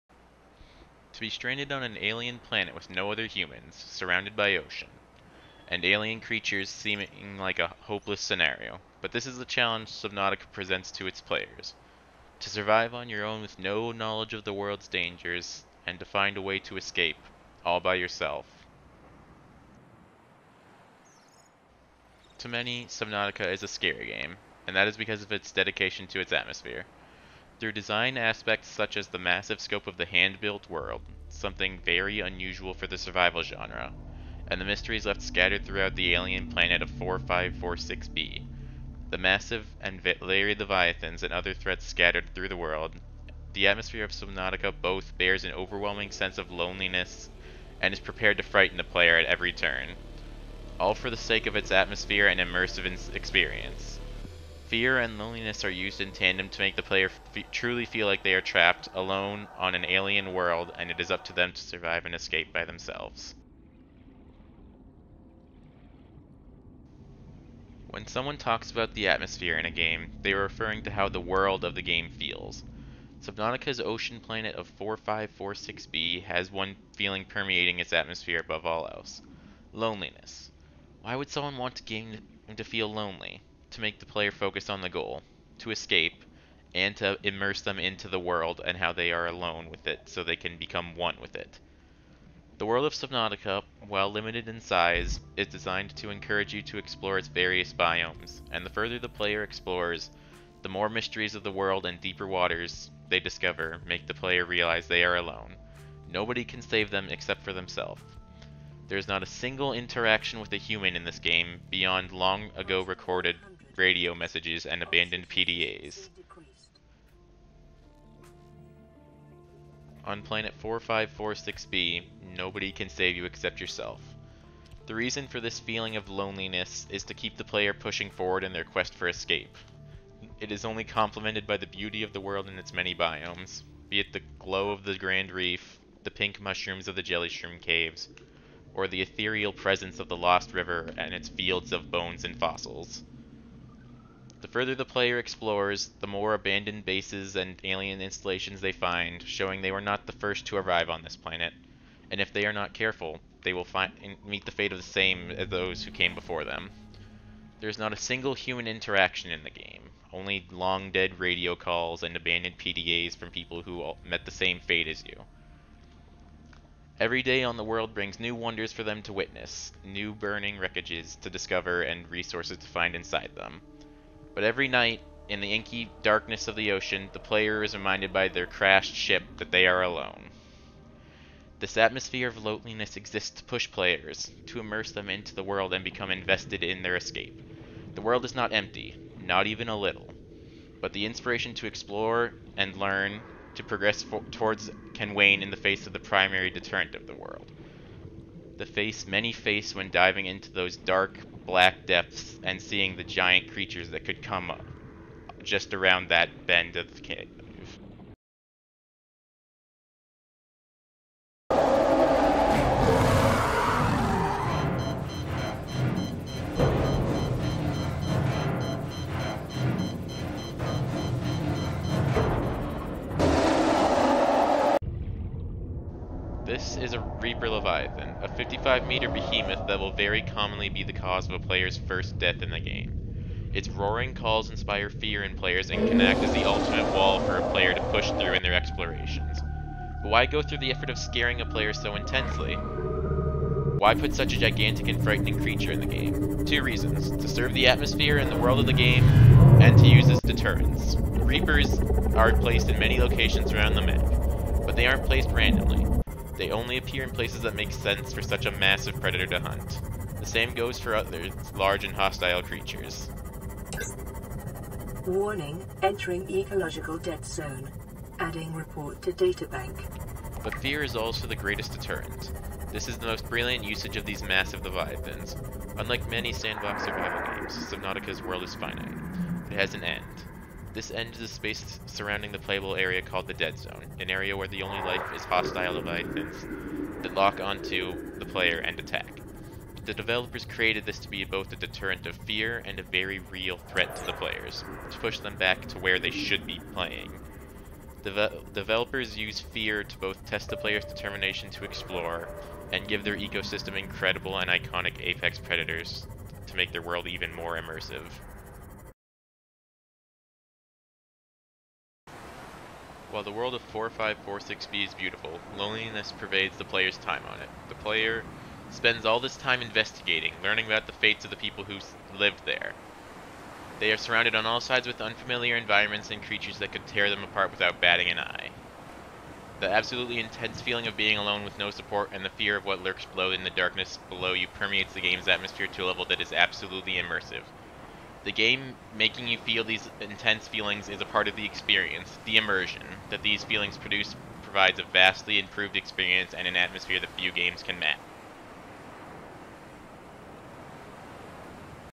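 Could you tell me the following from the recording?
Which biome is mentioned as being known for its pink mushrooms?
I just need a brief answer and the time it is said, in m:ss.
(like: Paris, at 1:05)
Jellyshroom Caves, at 2:17.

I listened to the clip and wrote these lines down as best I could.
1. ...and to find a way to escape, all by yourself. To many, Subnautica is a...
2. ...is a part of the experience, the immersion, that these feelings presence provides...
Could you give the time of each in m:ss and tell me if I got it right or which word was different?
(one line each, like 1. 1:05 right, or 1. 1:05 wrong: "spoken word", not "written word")
1. 0:15 right
2. 5:40 wrong: "produce", not "presence".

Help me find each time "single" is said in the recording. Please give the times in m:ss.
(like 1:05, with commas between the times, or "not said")
1:49, 2:37.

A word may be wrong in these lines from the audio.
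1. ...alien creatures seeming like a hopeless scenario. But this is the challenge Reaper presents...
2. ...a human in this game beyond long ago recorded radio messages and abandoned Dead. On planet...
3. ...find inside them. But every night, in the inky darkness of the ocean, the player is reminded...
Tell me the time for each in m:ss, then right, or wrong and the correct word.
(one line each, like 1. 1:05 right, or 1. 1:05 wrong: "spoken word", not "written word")
1. 0:05 wrong: "Subnautica", not "Reaper"
2. 1:50 wrong: "PDAs", not "Dead"
3. 2:52 right.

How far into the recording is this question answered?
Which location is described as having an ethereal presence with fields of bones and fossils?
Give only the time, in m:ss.
2:20.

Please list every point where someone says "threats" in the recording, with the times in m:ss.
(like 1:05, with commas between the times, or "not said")
0:41, 4:53.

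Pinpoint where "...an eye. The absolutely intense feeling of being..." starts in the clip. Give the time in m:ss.
5:28.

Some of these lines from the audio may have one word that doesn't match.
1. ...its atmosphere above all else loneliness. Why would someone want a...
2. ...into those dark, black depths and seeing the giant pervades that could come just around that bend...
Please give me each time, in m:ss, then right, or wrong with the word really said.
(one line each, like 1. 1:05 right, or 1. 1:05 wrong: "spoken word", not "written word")
1. 1:17 right
2. 3:20 wrong: "creatures", not "pervades".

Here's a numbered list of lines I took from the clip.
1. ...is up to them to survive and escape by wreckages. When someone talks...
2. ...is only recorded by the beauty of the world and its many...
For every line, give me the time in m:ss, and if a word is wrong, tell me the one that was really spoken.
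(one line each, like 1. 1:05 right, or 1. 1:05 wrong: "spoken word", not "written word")
1. 1:00 wrong: "themselves", not "wreckages"
2. 2:10 wrong: "complemented", not "recorded".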